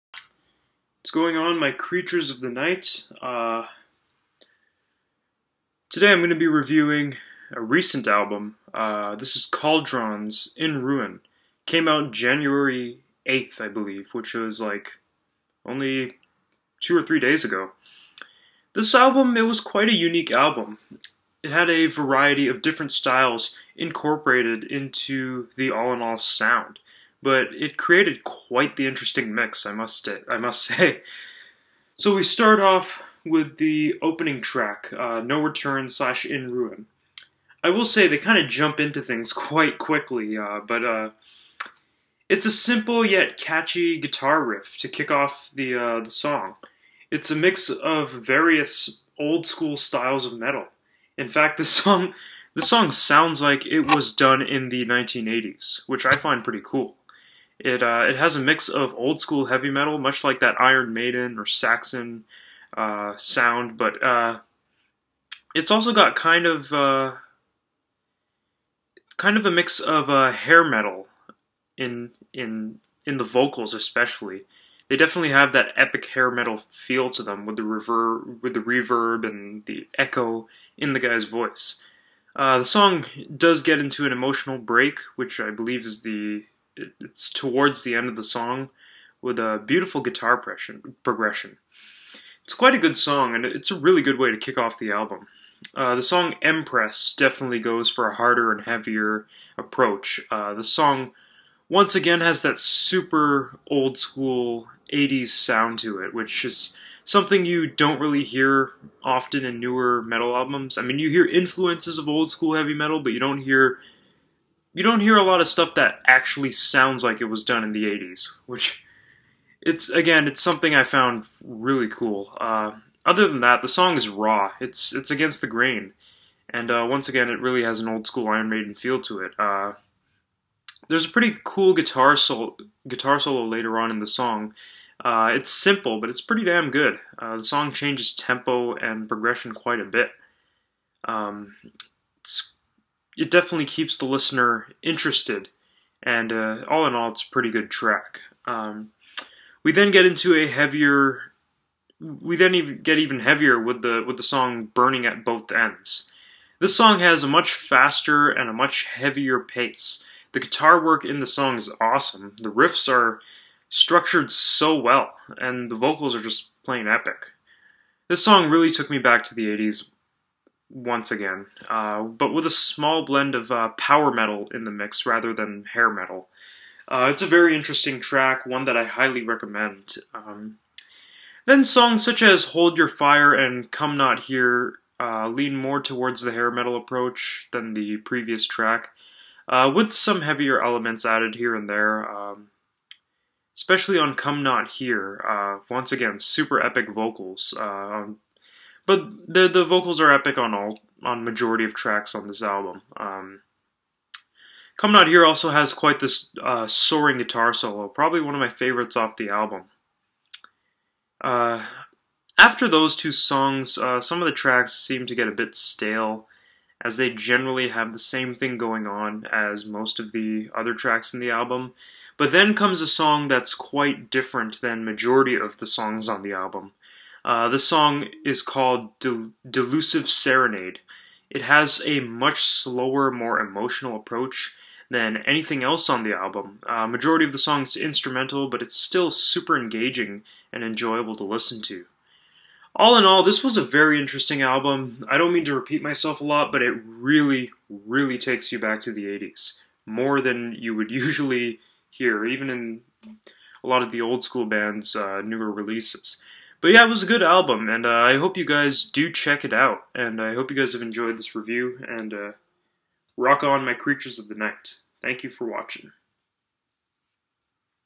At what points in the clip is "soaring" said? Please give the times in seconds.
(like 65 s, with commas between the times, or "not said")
206 s.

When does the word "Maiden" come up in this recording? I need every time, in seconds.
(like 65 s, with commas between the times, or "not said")
60 s, 128 s.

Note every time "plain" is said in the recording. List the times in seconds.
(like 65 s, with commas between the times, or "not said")
166 s.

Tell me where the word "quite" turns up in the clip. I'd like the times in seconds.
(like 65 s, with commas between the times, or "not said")
19 s, 28 s, 39 s, 92 s, 139 s, 205 s, 223 s.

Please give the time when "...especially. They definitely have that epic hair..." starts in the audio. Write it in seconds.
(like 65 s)
73 s.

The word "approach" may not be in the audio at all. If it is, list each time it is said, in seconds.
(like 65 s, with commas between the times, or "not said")
99 s, 186 s, 233 s.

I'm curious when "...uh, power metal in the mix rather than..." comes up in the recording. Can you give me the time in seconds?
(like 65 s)
173 s.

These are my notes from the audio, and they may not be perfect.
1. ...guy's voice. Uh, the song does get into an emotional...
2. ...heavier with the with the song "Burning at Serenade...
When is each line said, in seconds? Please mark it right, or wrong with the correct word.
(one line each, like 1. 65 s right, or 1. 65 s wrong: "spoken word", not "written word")
1. 80 s right
2. 153 s wrong: "Both", not "Serenade".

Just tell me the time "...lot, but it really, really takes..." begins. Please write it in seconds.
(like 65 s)
246 s.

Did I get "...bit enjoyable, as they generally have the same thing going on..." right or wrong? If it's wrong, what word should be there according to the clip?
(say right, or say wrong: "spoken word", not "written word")
wrong: "stale", not "enjoyable".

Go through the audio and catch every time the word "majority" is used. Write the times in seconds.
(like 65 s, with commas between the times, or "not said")
201 s, 224 s, 236 s.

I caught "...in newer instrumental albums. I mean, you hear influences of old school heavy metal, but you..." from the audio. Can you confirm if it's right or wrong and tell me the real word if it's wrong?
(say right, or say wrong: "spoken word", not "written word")
wrong: "metal", not "instrumental".